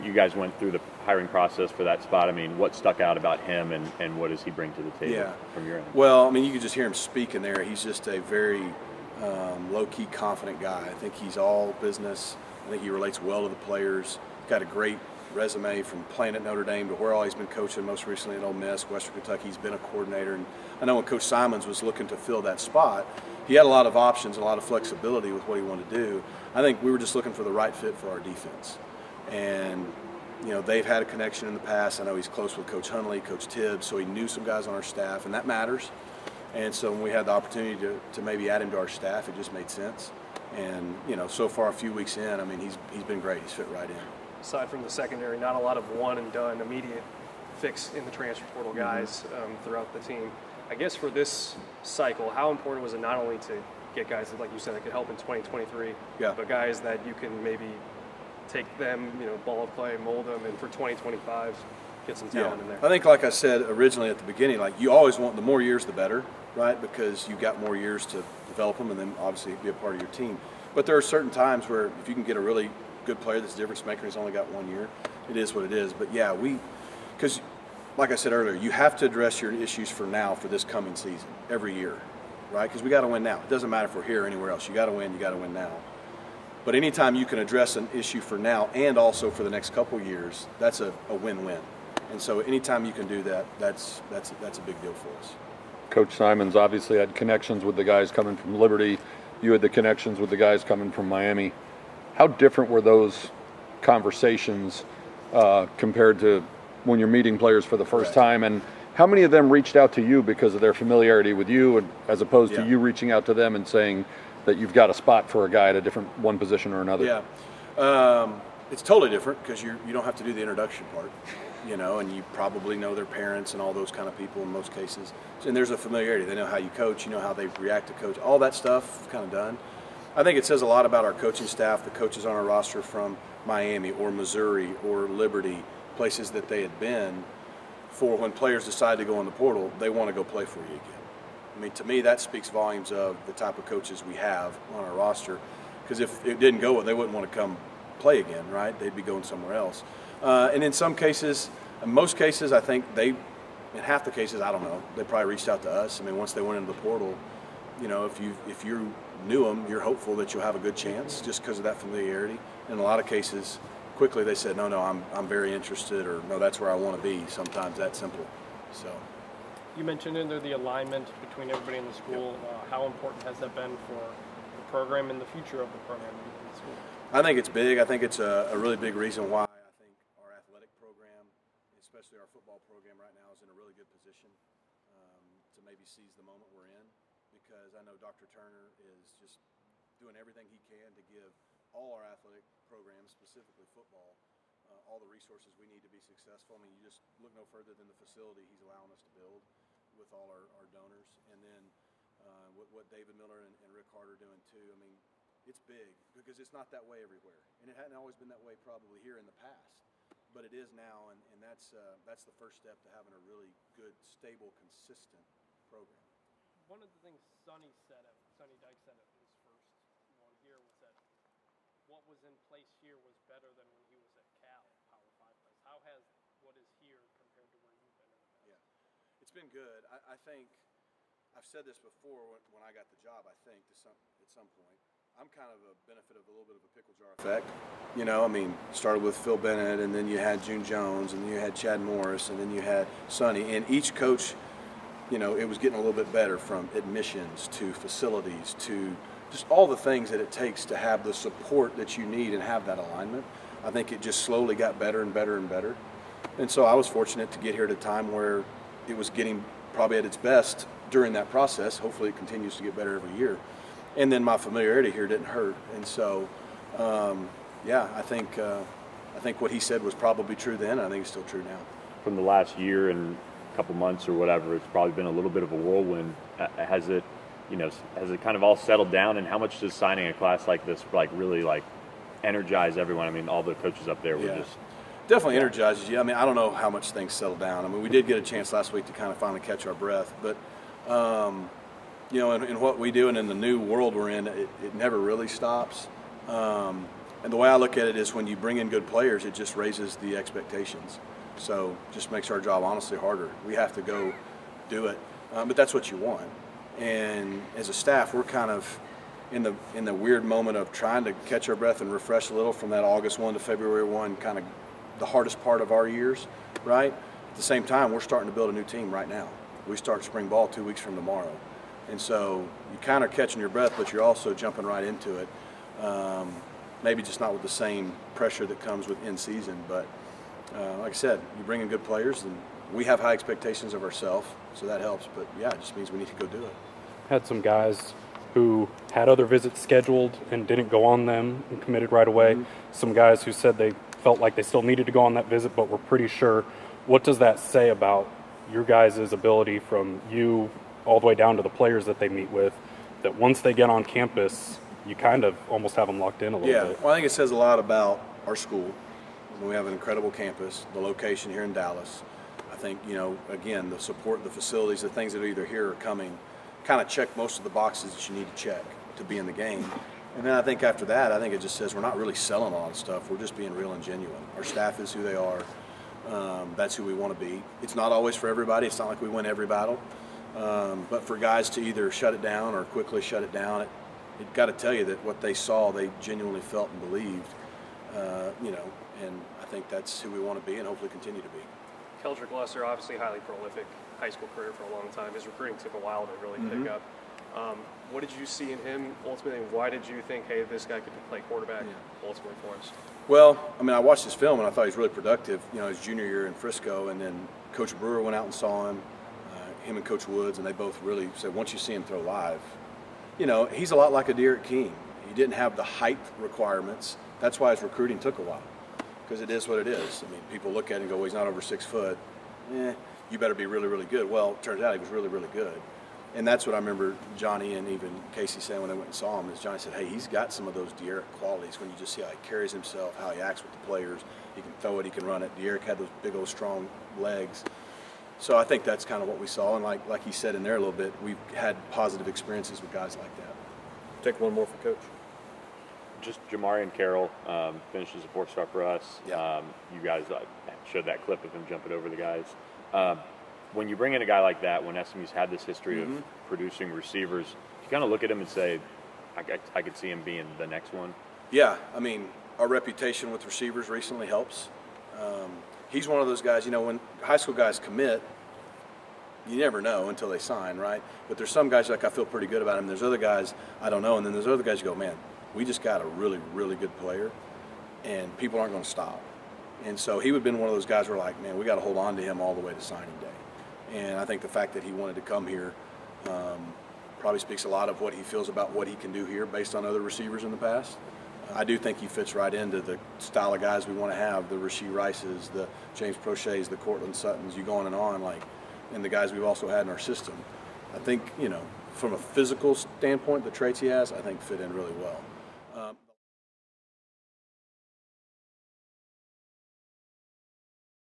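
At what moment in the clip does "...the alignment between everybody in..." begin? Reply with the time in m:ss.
2:50.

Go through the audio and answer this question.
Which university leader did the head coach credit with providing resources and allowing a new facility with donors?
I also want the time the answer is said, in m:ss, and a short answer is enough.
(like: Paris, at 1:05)
Dr. Turner, at 3:07.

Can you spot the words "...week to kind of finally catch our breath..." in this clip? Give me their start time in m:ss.
4:48.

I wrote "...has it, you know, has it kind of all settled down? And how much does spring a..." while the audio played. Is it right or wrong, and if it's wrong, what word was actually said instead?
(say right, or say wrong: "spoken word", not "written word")
wrong: "signing", not "spring".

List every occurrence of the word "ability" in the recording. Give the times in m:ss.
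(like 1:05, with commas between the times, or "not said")
5:49.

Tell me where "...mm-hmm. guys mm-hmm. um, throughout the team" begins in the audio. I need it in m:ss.
0:48.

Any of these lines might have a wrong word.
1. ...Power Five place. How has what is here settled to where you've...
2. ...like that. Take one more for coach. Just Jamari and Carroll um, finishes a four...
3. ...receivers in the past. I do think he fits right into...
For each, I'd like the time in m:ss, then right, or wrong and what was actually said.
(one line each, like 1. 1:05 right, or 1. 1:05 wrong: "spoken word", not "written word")
1. 3:44 wrong: "compared", not "settled"
2. 7:22 right
3. 8:09 right.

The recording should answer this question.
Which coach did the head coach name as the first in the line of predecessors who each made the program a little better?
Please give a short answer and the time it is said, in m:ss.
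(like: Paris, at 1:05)
Phil Bennett, at 3:59.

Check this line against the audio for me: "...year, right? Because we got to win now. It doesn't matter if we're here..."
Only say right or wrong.
right.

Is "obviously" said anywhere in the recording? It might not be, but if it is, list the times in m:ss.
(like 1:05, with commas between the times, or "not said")
1:09, 1:36, 6:32.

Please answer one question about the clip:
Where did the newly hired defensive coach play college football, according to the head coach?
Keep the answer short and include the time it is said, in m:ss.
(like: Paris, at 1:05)
Notre Dame, at 0:16.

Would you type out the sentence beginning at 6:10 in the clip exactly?
And then I think after that, I think it just says we're not really selling a lot of stuff.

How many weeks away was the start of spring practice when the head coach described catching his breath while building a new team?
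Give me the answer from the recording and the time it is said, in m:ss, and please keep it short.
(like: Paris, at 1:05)
2, at 5:20.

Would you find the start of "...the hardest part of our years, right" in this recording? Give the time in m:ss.
5:14.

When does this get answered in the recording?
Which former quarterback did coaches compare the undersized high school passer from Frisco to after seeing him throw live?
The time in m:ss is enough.
6:54.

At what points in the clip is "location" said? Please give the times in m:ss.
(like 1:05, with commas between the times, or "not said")
6:00.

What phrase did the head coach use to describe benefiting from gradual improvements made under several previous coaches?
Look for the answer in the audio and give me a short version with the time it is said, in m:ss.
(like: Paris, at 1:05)
pickle jar effect, at 3:56.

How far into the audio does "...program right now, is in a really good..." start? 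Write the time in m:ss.
3:02.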